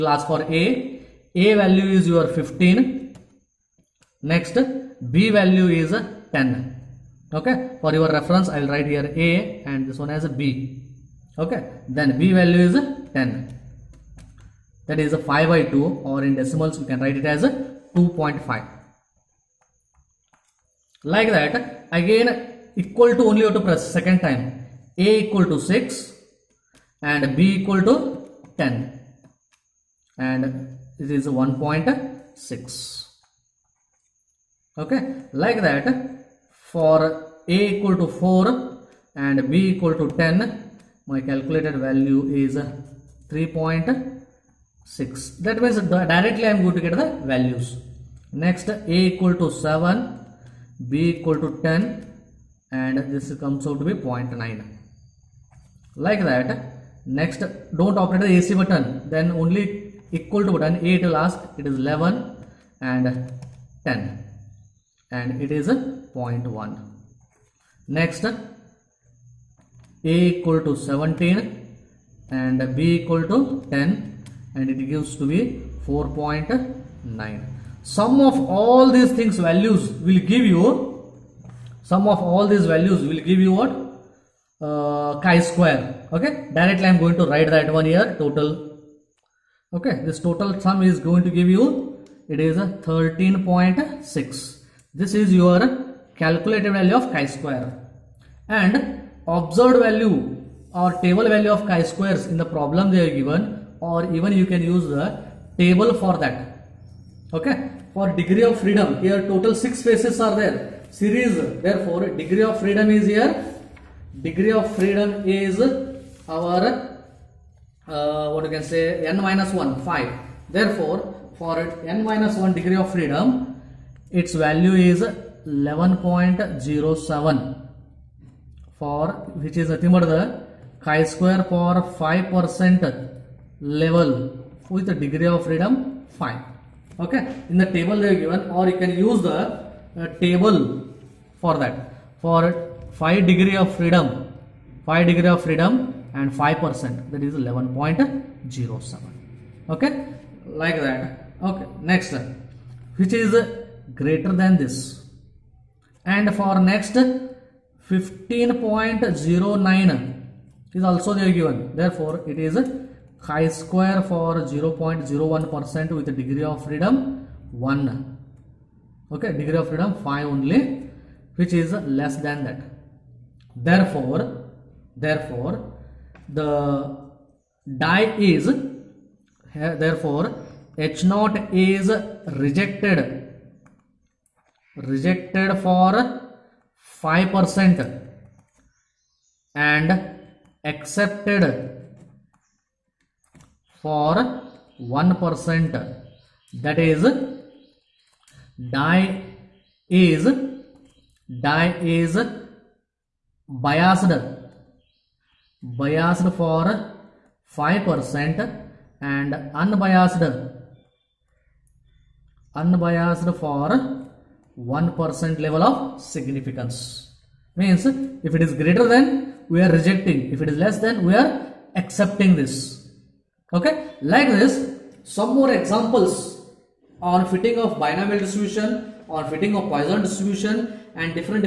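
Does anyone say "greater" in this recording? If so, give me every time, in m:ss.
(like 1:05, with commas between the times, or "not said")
2:34, 3:38.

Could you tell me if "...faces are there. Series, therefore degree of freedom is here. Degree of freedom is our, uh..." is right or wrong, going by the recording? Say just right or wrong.
right.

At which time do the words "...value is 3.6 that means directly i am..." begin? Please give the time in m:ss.
0:41.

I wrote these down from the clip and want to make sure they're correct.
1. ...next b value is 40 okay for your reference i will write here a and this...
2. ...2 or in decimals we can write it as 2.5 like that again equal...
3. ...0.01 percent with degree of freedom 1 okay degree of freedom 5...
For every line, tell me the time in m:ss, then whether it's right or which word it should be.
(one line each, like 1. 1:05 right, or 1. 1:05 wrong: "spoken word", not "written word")
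1. 0:04 wrong: "10", not "40"
2. 0:15 right
3. 2:44 right.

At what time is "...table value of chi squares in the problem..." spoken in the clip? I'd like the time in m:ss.
1:41.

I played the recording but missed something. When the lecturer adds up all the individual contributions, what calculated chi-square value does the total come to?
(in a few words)
13.6.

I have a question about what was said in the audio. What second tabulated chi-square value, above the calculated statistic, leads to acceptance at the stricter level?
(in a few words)
15.09.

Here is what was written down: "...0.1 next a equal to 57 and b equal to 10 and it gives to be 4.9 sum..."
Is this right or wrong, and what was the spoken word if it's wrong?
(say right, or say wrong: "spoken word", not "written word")
wrong: "17", not "57".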